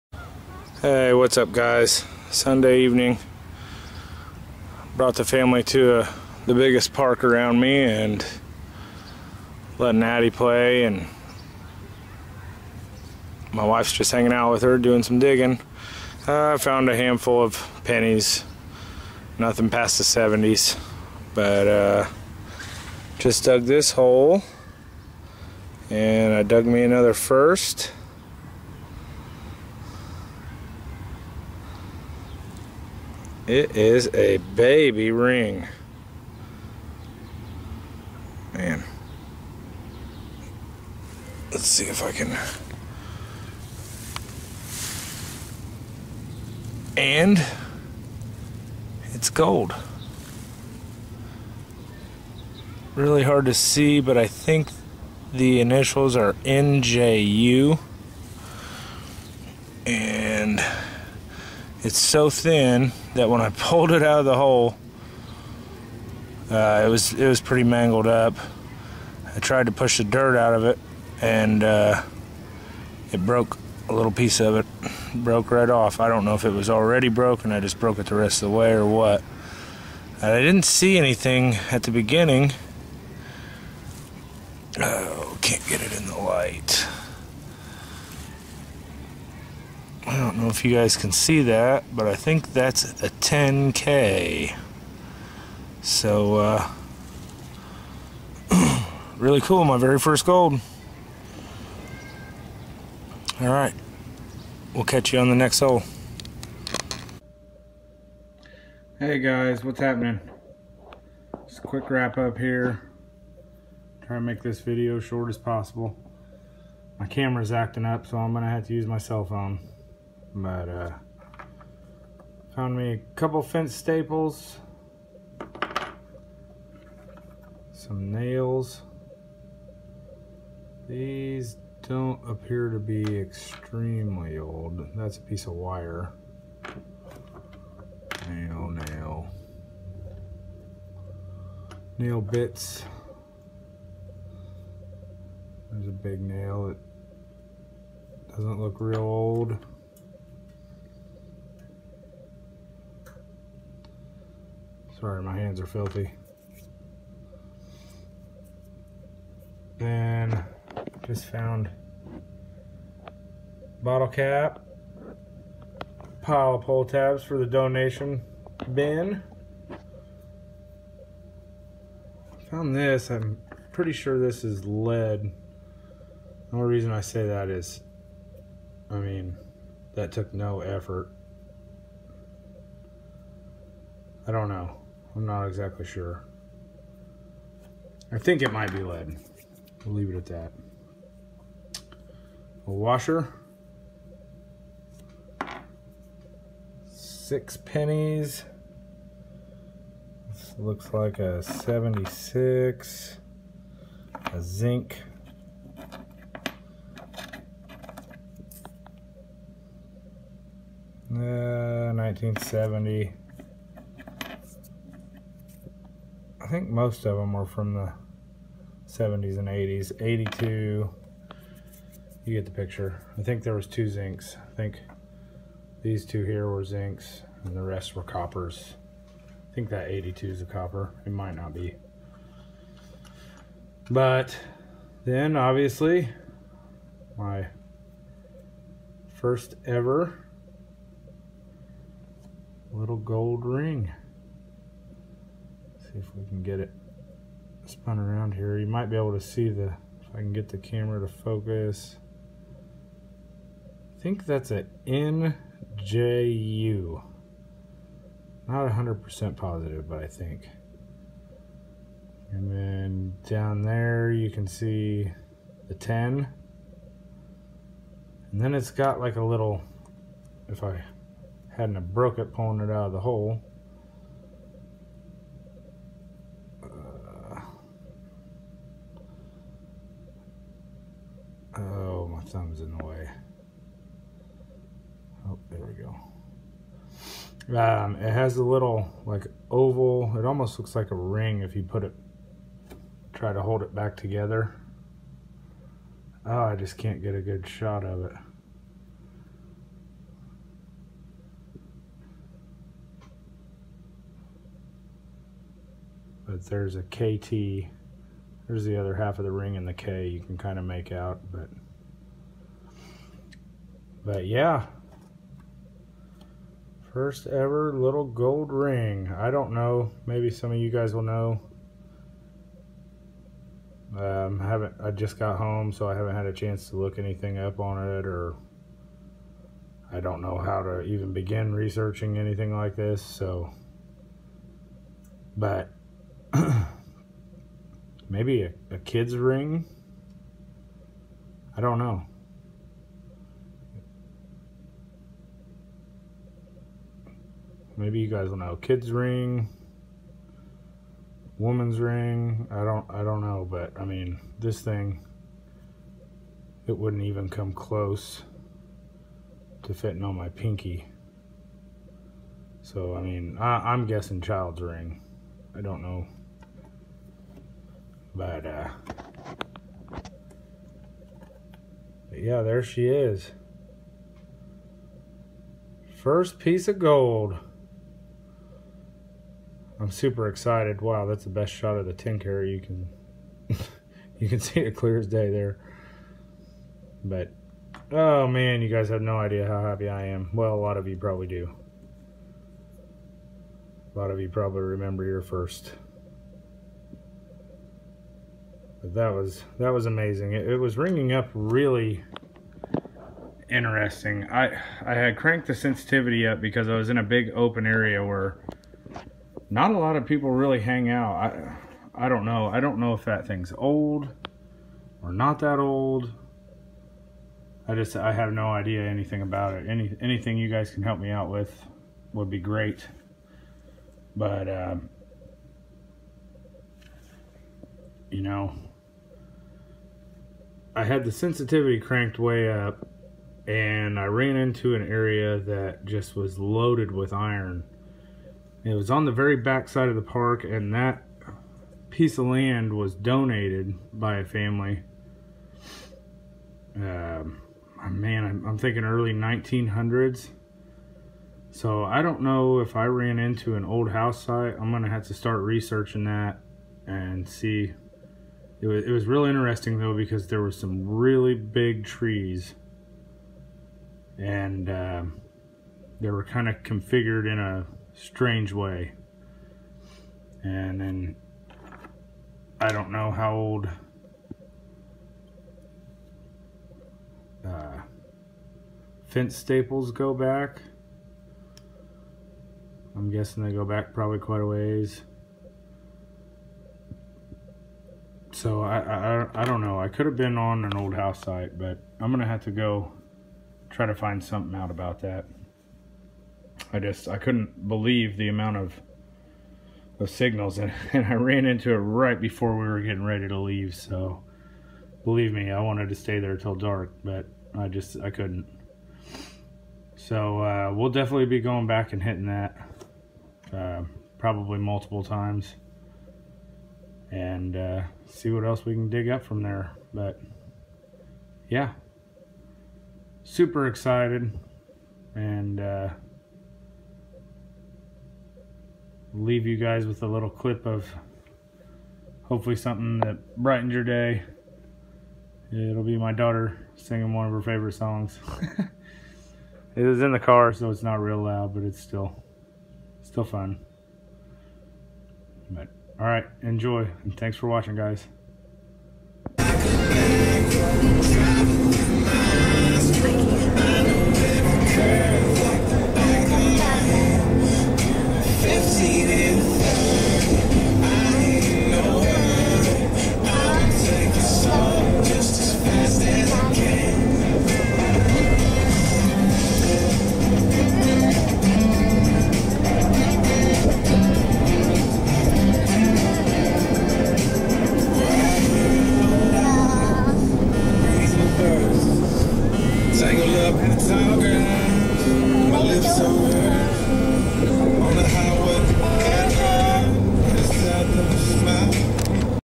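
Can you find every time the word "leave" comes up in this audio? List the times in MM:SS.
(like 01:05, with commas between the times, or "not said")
03:09, 08:23, 08:49.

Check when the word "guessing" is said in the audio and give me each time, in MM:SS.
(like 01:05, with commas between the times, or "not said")
06:03, 08:03.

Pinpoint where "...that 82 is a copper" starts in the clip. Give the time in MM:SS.
03:49.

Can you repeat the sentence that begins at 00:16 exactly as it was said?
Uh, I uh, found a handful of pennies.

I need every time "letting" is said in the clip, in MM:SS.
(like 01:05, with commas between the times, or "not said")
00:09.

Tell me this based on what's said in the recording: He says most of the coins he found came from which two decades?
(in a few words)
70s and 80s.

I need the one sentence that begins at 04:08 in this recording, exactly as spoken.
You might be able to see the, if I can get the camera to focus.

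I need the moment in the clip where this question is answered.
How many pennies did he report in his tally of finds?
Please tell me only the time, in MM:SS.
03:16.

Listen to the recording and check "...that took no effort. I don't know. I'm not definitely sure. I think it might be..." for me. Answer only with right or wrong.
wrong.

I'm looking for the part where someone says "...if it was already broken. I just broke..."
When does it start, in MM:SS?
01:16.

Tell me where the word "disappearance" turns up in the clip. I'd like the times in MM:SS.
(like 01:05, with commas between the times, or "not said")
not said.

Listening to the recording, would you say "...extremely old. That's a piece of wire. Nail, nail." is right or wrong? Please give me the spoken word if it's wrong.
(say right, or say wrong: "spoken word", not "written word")
right.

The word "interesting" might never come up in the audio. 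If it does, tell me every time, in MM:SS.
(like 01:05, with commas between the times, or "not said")
06:43, 07:39.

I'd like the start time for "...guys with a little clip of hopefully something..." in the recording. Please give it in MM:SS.
08:49.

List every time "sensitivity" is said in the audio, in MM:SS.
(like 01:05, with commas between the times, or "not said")
06:45, 07:11.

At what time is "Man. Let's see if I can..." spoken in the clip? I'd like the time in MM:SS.
00:38.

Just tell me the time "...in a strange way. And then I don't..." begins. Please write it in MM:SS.
07:47.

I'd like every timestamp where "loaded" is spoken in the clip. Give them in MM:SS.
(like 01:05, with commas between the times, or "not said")
07:16.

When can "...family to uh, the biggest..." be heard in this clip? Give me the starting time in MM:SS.
00:05.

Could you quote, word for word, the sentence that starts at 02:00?
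But uh, found me a couple fence staples, some nails.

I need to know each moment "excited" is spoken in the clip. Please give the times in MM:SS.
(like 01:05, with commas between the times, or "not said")
06:20, 08:43.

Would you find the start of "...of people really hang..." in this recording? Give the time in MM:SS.
06:49.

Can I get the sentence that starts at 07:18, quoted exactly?
It was on the very back side of the park, and that piece of land was donated by a family.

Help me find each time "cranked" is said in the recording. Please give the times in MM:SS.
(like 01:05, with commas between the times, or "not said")
06:45, 07:11.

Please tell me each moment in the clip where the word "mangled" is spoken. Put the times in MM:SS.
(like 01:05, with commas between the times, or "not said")
01:07.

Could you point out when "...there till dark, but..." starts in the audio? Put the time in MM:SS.
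08:26.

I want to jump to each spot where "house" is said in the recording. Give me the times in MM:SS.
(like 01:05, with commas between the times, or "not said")
07:33, 08:10.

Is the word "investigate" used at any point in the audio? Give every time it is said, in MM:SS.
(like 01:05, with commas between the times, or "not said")
not said.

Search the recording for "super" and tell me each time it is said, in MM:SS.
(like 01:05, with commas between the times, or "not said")
06:19, 08:43.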